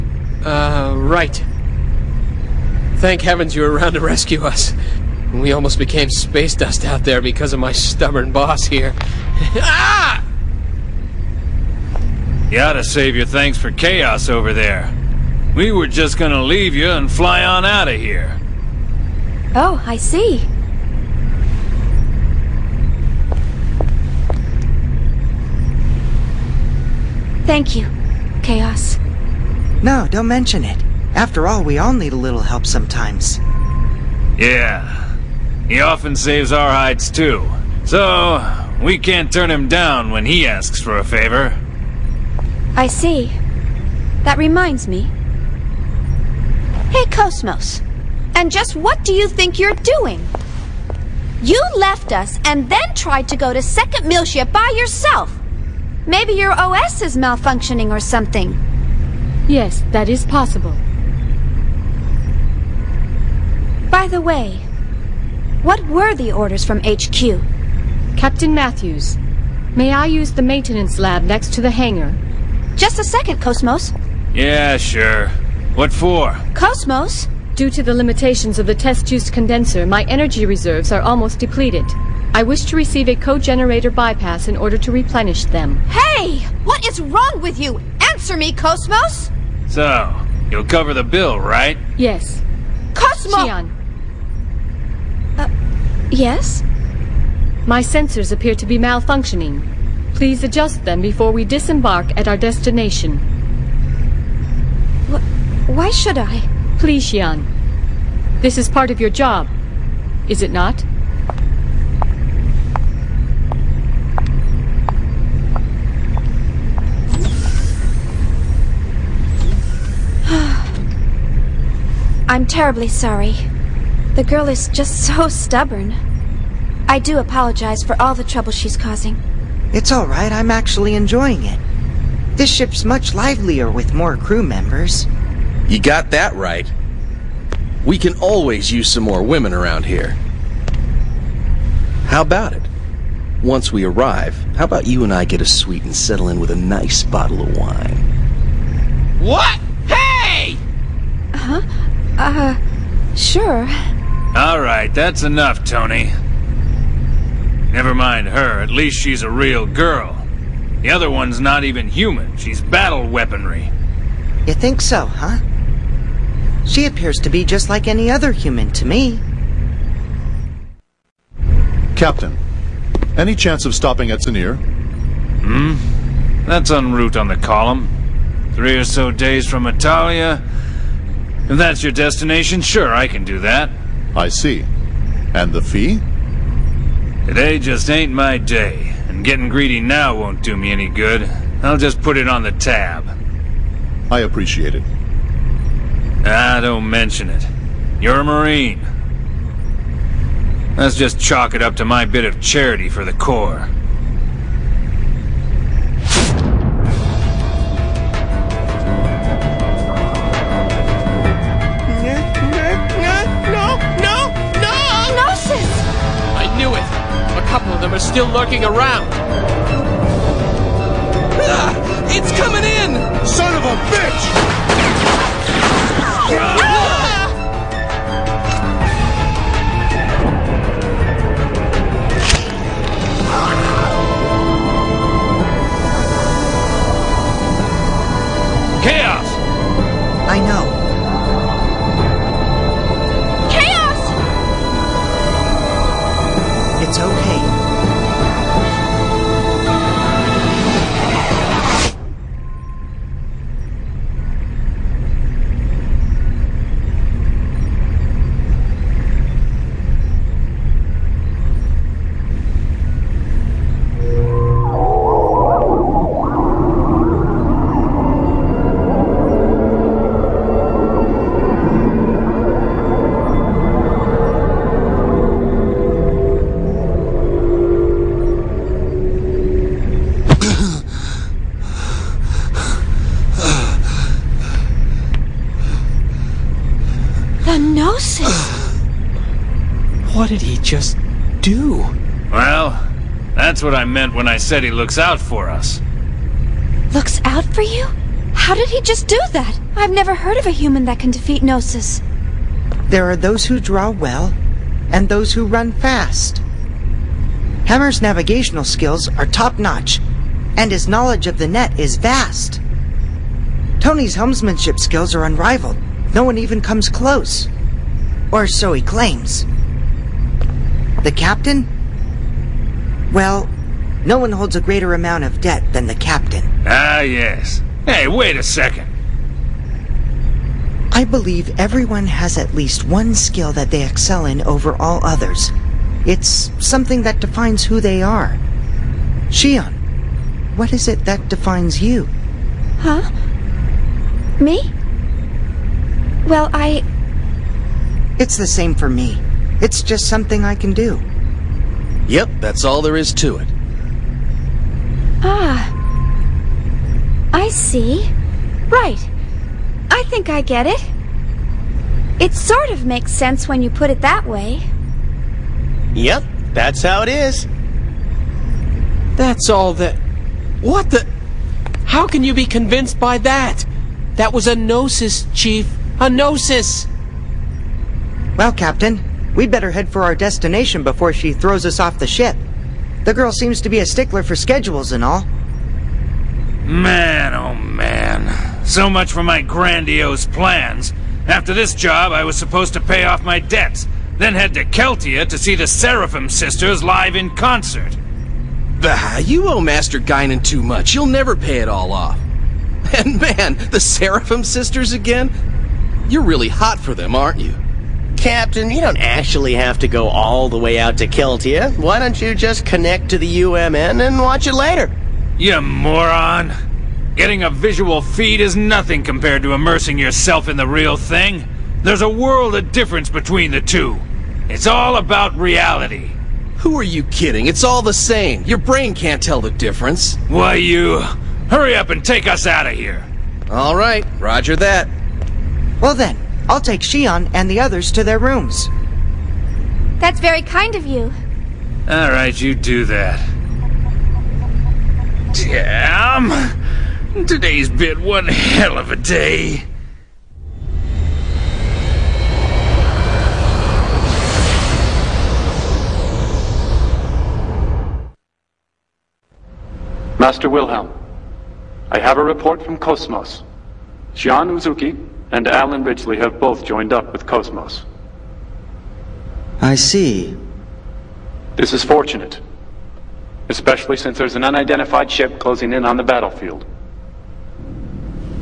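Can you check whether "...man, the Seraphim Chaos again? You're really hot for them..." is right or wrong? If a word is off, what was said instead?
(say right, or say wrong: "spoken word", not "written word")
wrong: "Sisters", not "Chaos".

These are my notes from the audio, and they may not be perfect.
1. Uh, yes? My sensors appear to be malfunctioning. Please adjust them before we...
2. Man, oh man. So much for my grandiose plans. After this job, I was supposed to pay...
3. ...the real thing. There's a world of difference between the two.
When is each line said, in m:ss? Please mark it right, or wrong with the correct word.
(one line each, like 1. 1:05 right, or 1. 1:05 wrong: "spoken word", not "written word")
1. 1:35 right
2. 6:26 right
3. 7:00 right.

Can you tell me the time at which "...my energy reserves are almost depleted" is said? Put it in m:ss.
1:19.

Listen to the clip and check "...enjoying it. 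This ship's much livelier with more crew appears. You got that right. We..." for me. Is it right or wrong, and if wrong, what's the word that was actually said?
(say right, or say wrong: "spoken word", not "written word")
wrong: "members", not "appears".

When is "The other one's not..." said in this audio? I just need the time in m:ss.
2:40.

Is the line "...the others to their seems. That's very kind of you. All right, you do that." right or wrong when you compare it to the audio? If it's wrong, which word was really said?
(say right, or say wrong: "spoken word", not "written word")
wrong: "rooms", not "seems".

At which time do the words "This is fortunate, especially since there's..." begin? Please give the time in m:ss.
7:51.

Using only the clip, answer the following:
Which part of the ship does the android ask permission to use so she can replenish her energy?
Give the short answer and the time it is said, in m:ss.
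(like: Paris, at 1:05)
maintenance lab, at 1:10.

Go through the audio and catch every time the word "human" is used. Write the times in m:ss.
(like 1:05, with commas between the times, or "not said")
2:41, 2:48, 5:00.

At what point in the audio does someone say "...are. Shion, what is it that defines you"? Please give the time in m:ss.
5:38.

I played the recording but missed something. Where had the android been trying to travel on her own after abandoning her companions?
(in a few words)
Second Miltia.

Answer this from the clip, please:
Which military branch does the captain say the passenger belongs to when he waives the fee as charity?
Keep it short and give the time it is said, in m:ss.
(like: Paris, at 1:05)
Marine, at 3:18.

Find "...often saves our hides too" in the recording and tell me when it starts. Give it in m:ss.
0:35.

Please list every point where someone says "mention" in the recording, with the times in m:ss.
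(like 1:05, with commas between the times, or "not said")
0:30, 3:16.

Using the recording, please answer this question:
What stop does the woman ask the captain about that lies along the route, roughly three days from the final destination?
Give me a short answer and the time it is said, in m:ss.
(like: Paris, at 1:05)
Zanir, at 2:54.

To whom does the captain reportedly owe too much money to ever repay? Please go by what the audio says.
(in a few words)
Master Guinan.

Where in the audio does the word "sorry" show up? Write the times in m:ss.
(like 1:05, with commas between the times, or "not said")
2:02.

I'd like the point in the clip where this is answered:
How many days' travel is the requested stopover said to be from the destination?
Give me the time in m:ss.
2:58.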